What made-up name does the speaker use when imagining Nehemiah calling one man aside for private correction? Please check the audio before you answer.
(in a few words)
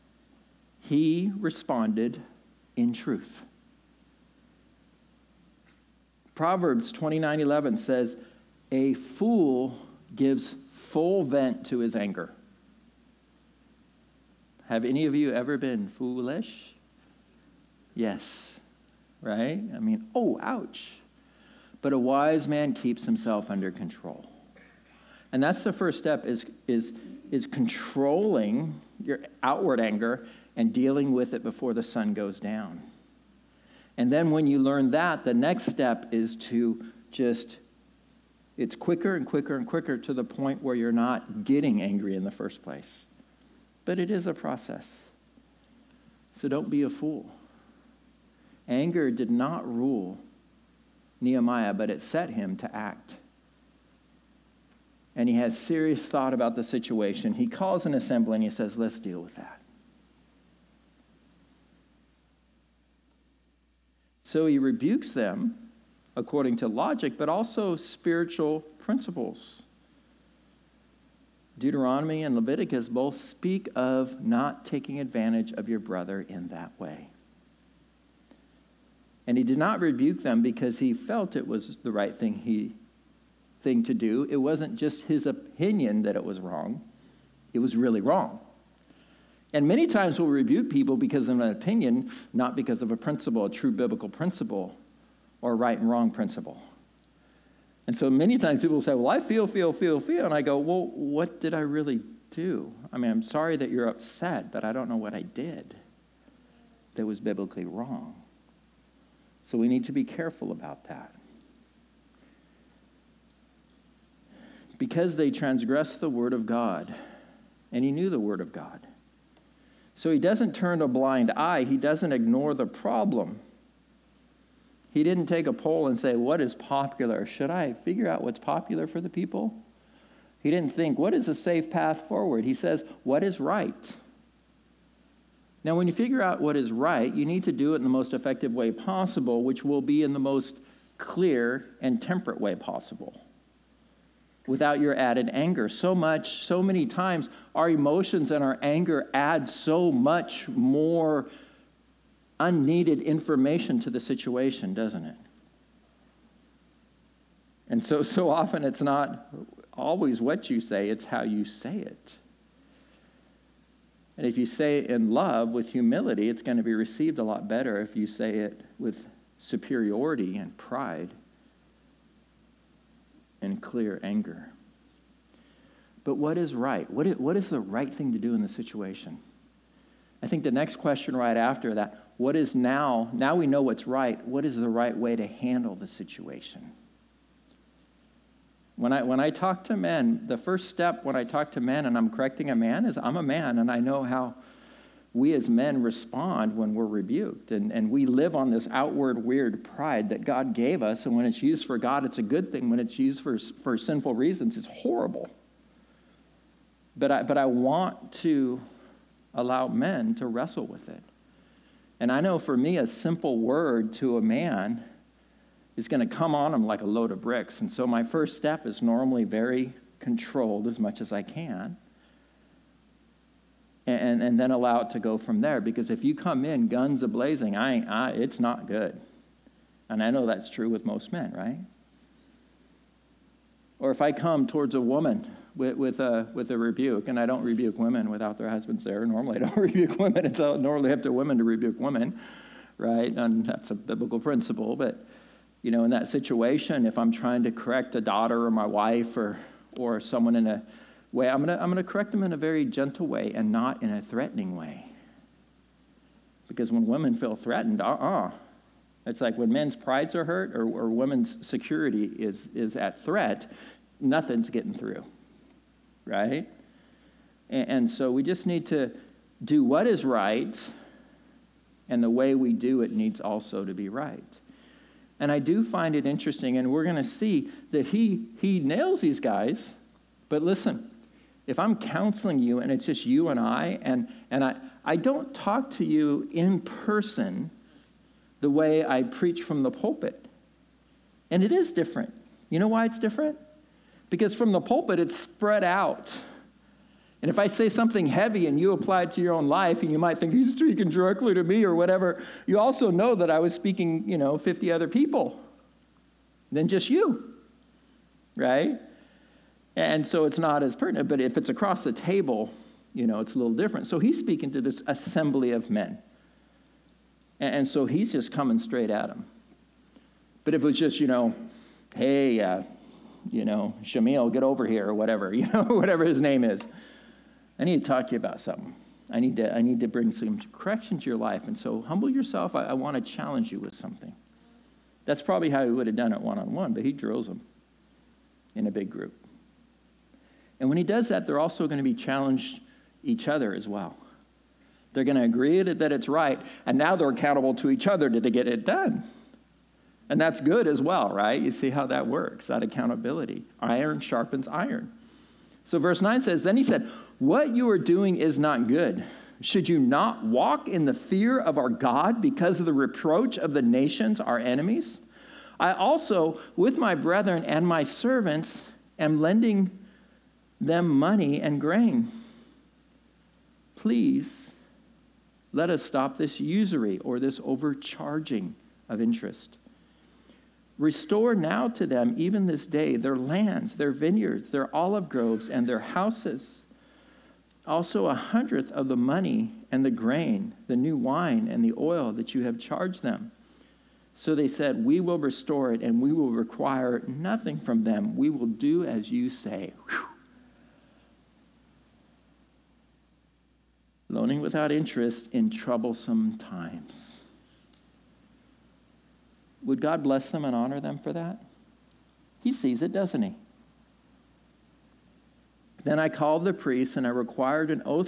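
Shamil.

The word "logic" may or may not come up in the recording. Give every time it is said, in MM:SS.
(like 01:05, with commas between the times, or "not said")
01:06.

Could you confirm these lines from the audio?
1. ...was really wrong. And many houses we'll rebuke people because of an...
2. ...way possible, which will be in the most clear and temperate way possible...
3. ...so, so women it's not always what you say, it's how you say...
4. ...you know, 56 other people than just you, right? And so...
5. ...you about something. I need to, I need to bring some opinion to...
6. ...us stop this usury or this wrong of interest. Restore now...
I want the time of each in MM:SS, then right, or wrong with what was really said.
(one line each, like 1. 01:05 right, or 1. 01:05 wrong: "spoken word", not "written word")
1. 01:27 wrong: "times", not "houses"
2. 02:18 right
3. 02:37 wrong: "often", not "women"
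4. 05:04 wrong: "50", not "56"
5. 05:28 wrong: "correction", not "opinion"
6. 06:15 wrong: "overcharging", not "wrong".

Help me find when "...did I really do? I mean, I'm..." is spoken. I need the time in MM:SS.
01:41.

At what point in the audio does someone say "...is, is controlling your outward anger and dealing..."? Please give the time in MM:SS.
00:26.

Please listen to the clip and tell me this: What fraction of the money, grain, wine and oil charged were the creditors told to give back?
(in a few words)
A hundredth.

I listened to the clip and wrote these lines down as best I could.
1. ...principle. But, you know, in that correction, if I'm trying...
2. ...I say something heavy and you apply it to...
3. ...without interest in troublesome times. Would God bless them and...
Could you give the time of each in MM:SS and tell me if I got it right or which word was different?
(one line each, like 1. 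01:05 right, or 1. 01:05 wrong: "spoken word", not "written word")
1. 04:04 wrong: "situation", not "correction"
2. 04:57 right
3. 06:44 right.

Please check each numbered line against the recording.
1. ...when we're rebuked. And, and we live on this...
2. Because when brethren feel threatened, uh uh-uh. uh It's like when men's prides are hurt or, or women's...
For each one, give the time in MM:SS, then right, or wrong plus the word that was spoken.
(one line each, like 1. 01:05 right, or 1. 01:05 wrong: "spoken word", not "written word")
1. 03:16 right
2. 04:16 wrong: "women", not "brethren".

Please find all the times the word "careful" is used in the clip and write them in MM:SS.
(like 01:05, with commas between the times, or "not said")
01:50.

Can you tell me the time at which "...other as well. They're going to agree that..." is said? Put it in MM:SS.
05:43.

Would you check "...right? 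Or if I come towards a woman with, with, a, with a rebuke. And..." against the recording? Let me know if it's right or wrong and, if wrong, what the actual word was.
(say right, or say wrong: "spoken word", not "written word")
right.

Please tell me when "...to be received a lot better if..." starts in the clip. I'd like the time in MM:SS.
02:46.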